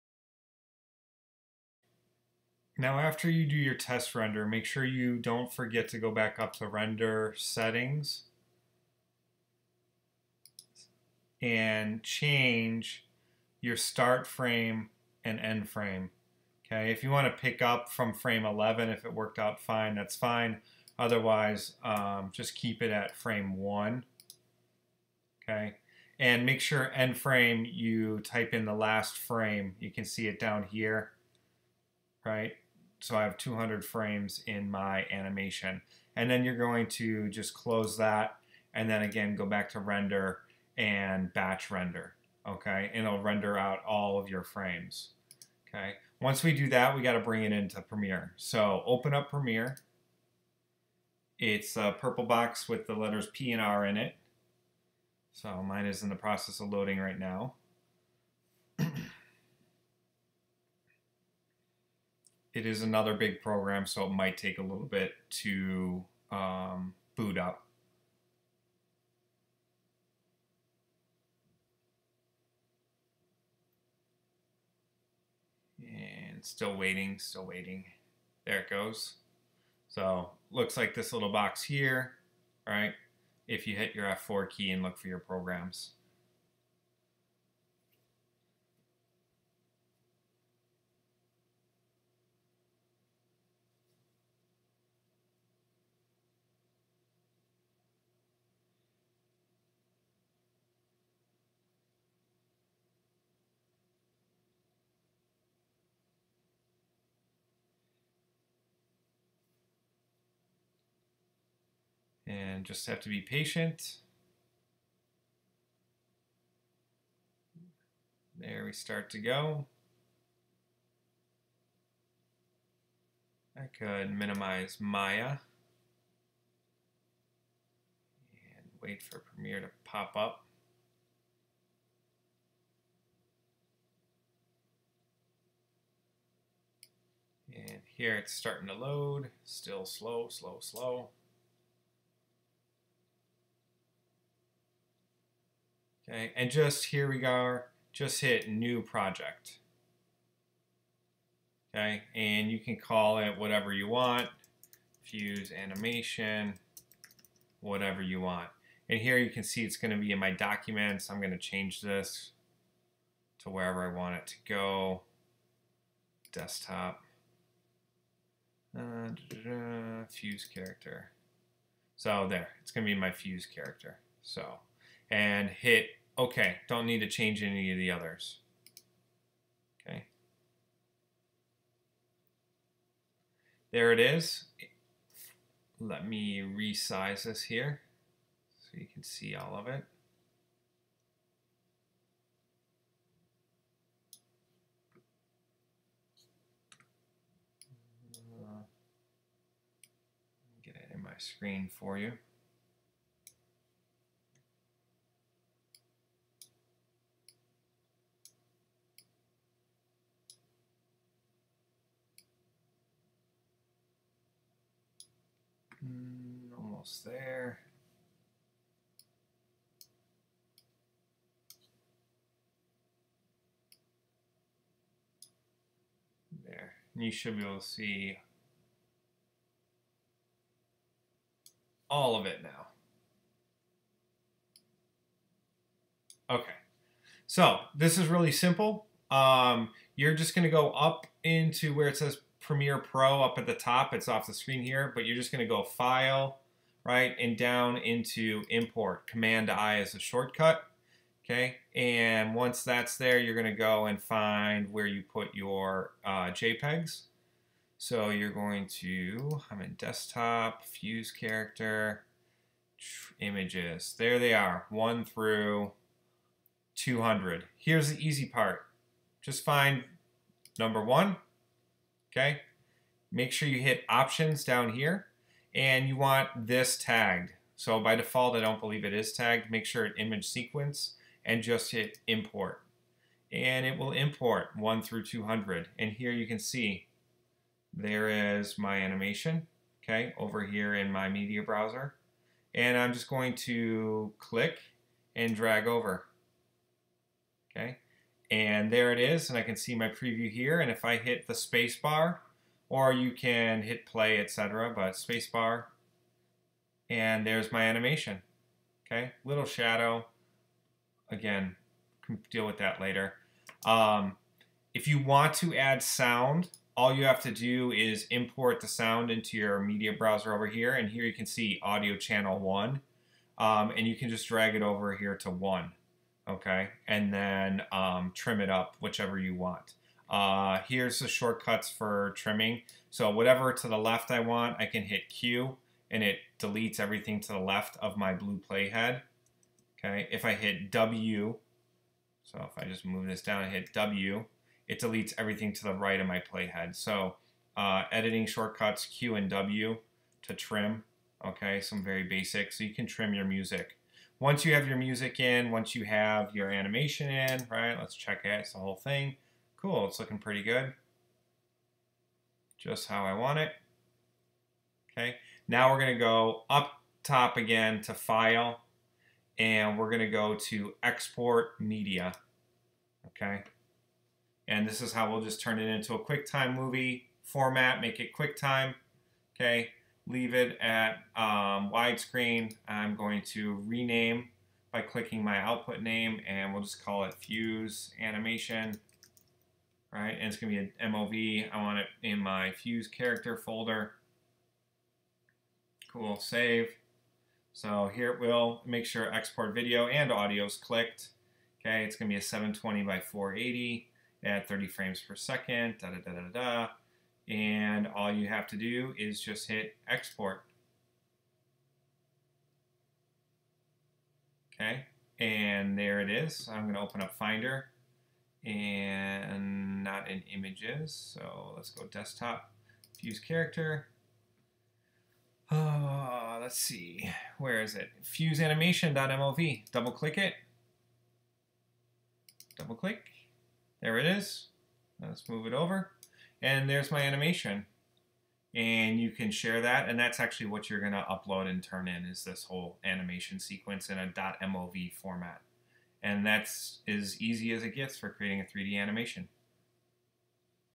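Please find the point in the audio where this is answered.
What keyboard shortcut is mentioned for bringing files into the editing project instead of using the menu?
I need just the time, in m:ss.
4:09.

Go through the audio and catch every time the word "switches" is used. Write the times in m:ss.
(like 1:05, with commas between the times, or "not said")
not said.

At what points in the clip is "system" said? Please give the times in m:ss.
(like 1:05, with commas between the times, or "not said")
not said.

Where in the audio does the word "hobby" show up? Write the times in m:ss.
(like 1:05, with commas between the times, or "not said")
not said.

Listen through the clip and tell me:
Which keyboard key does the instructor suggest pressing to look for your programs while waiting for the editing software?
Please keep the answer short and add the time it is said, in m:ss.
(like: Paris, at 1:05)
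F4, at 1:24.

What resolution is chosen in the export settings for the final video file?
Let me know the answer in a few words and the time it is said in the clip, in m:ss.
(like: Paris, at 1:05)
720 by 480, at 6:42.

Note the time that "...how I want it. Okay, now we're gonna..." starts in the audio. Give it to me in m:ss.
6:02.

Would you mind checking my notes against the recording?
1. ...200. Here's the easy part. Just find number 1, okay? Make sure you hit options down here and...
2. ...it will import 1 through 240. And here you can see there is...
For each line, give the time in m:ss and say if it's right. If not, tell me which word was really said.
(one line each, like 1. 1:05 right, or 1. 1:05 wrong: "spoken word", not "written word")
1. 4:26 right
2. 4:43 wrong: "200", not "240".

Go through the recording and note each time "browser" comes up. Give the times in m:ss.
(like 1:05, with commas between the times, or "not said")
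4:51, 5:19.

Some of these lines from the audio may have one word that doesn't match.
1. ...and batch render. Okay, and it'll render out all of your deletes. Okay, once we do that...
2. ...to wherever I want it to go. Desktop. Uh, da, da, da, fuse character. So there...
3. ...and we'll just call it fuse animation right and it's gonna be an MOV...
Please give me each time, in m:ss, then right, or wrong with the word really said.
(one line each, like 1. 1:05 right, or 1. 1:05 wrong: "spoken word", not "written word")
1. 0:40 wrong: "frames", not "deletes"
2. 2:43 right
3. 6:26 right.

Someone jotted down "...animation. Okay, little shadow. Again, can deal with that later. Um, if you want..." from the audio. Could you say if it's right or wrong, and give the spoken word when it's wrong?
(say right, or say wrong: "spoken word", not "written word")
right.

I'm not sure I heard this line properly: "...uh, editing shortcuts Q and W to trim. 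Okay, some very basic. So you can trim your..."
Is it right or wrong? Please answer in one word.
right.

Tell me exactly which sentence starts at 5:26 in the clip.
And then um, trim it up whichever you want.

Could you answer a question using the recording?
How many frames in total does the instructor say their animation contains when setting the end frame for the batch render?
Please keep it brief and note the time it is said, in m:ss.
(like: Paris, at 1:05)
200, at 0:33.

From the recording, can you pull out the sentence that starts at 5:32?
So whatever to the left I want, I can hit Q and it deletes everything to the left of my blue playhead.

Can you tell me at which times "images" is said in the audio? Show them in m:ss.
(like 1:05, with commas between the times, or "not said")
4:23, 4:39, 7:00.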